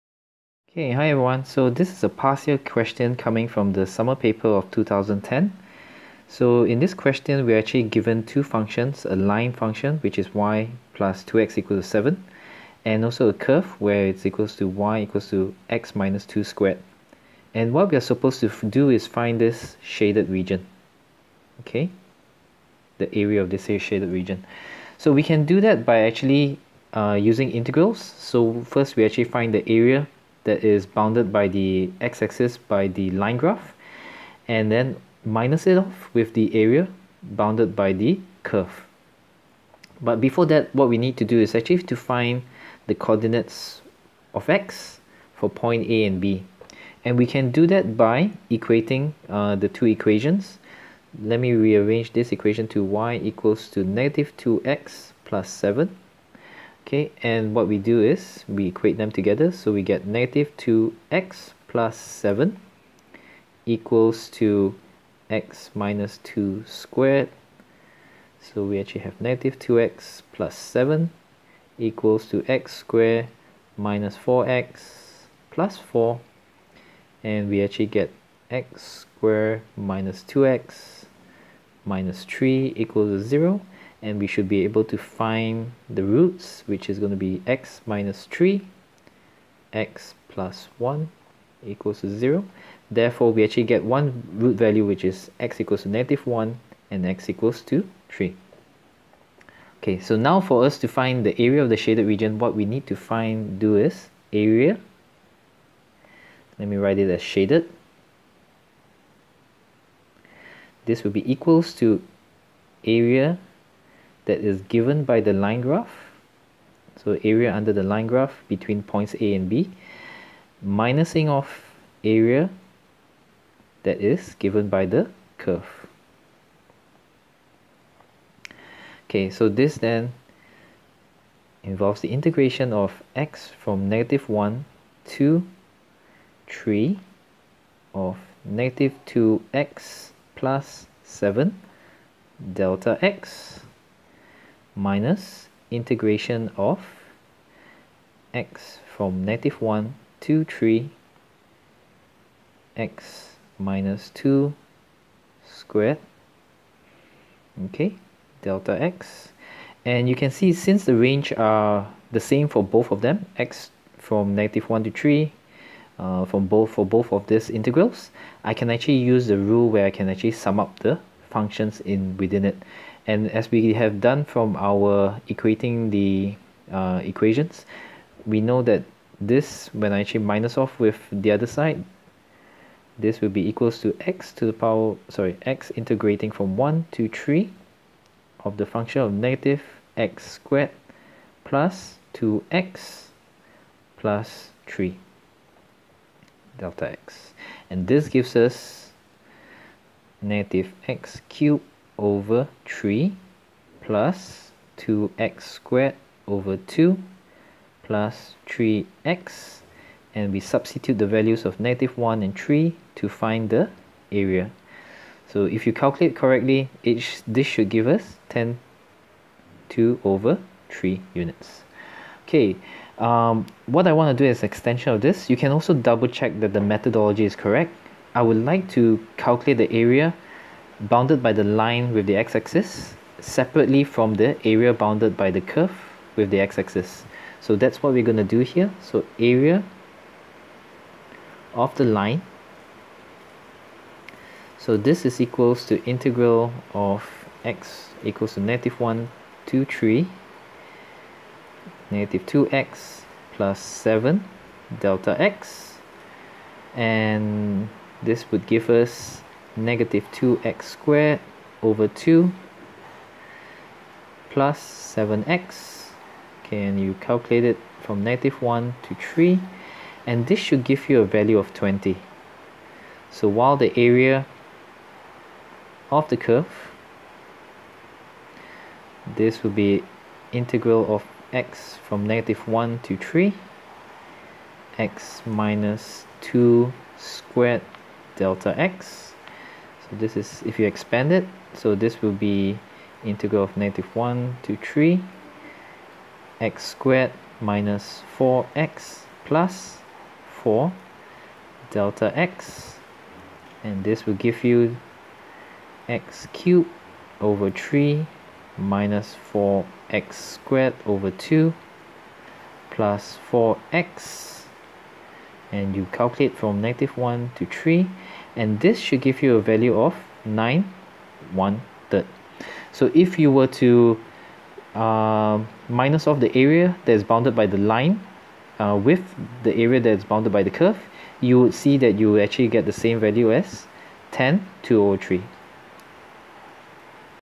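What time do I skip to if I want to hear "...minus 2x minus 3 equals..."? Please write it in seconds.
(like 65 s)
79 s.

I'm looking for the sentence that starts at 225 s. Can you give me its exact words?
You can also double check that the methodology is correct.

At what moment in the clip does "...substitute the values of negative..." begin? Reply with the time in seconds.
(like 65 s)
210 s.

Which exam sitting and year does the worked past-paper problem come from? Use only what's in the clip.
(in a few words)
Summer 2010.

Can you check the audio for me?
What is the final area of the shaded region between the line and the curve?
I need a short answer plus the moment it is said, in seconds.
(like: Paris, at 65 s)
10 2/3 units, at 218 s.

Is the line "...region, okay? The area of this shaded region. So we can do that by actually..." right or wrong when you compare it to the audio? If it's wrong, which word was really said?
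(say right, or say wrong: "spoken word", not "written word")
right.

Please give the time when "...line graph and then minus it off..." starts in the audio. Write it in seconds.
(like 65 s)
33 s.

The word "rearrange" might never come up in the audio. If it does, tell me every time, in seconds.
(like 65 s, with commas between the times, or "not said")
51 s.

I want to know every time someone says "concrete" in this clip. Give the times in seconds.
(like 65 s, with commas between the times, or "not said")
not said.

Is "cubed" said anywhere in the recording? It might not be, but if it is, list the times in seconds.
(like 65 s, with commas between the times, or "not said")
201 s, 306 s.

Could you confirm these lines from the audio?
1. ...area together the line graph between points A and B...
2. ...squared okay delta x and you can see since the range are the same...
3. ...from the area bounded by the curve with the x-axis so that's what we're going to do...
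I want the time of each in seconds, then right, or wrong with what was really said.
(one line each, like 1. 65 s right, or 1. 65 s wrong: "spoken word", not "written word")
1. 117 s wrong: "under", not "together"
2. 155 s right
3. 233 s right.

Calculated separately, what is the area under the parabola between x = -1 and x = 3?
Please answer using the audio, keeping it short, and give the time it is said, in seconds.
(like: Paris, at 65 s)
9 1/3, at 320 s.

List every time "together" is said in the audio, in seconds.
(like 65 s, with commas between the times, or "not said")
59 s.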